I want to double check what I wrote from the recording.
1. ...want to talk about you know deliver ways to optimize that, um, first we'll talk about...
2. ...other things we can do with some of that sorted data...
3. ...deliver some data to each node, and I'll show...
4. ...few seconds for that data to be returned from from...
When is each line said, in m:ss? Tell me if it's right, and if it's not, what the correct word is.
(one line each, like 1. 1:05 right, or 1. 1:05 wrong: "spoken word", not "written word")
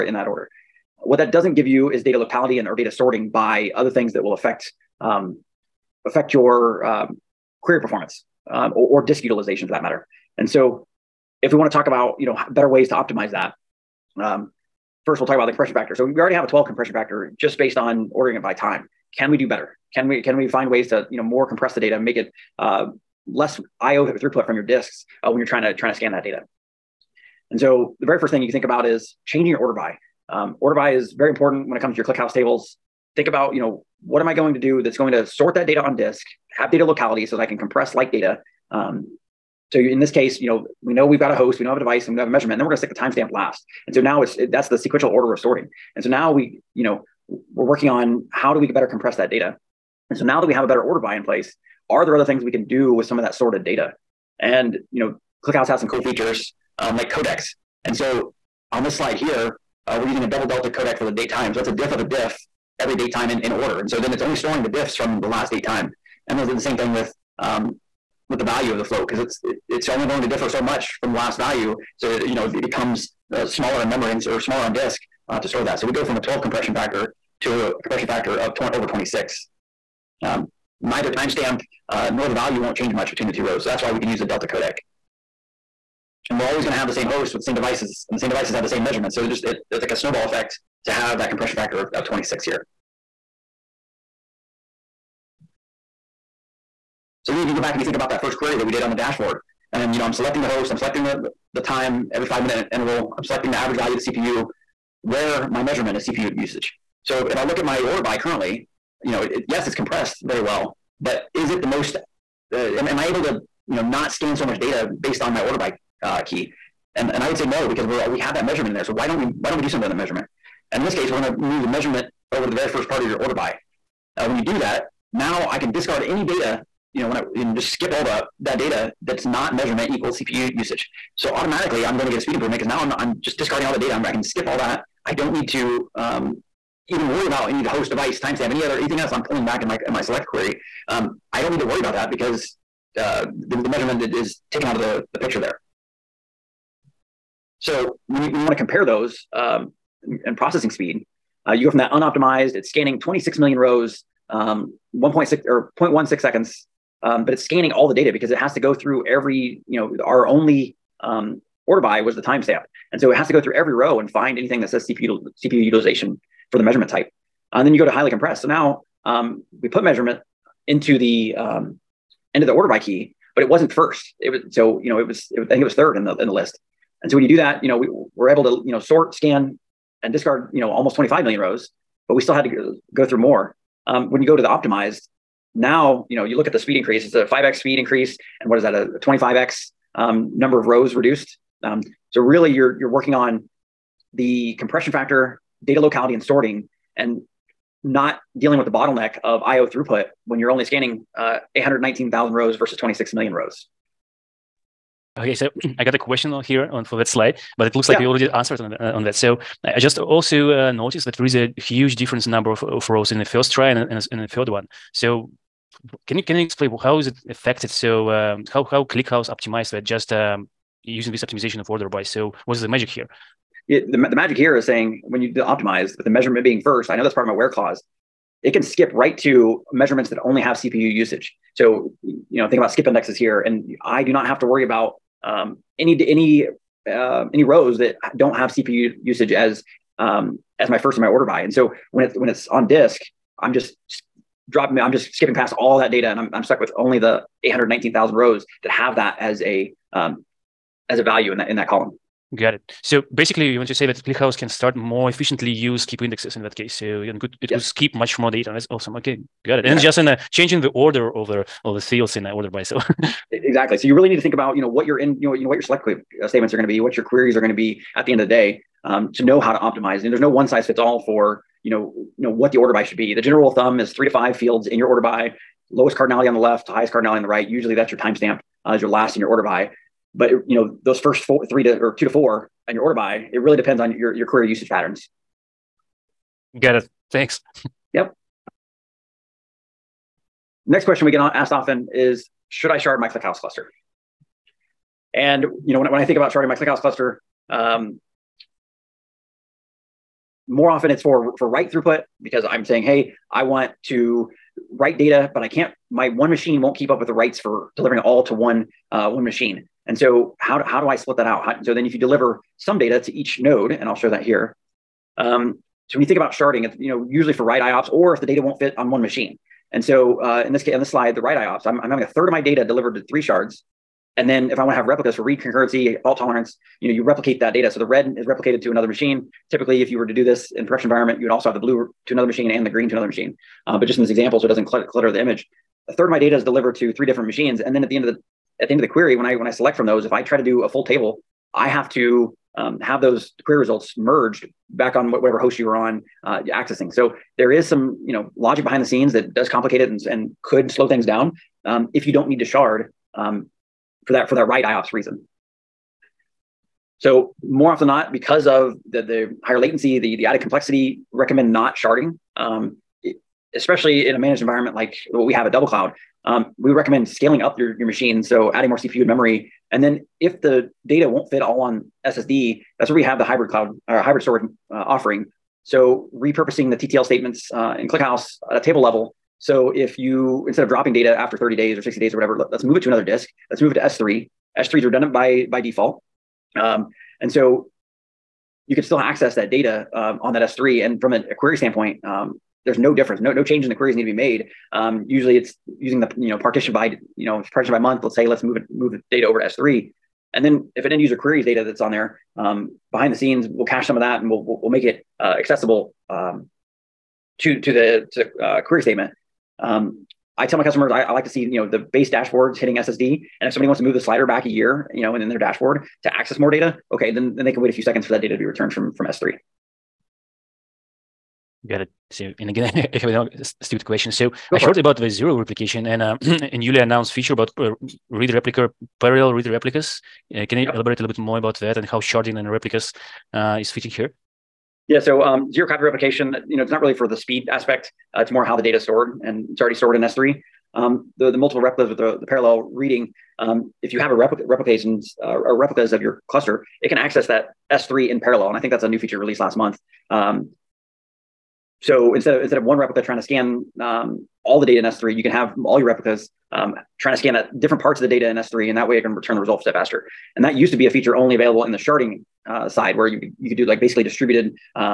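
1. 0:11 wrong: "better", not "deliver"
2. 0:52 right
3. 5:11 right
4. 6:57 right.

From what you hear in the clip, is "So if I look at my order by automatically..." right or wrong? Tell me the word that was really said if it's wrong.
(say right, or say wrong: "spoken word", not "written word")
wrong: "currently", not "automatically".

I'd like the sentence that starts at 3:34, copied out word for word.
So can you can you explain how is it affected?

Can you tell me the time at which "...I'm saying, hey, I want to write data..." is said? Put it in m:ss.
5:02.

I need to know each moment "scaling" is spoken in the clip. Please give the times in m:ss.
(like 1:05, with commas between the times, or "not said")
6:07.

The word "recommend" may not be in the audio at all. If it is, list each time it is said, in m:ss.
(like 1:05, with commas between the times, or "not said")
6:01, 6:06.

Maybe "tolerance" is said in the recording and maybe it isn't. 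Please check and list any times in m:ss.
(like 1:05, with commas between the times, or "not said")
5:26.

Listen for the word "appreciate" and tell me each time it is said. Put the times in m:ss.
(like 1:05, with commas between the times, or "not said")
not said.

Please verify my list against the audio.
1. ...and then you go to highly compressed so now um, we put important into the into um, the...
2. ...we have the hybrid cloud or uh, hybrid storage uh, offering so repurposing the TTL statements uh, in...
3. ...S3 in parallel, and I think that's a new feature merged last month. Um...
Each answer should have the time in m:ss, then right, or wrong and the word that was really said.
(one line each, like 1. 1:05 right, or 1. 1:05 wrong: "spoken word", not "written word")
1. 2:47 wrong: "measurement", not "important"
2. 6:12 right
3. 7:27 wrong: "released", not "merged".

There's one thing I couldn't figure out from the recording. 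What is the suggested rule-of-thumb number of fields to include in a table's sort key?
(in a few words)
3 to 5.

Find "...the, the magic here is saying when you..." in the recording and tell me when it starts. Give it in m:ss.
3:43.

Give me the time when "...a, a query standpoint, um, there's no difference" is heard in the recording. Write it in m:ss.
6:31.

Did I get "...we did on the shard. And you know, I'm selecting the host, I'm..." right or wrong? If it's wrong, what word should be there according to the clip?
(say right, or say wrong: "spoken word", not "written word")
wrong: "dashboard", not "shard".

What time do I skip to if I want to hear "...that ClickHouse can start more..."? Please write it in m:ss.
4:13.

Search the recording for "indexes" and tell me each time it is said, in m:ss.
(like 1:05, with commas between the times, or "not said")
3:52, 4:16.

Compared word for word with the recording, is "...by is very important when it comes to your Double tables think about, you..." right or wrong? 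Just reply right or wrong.
wrong.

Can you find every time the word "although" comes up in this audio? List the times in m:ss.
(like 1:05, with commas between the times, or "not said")
not said.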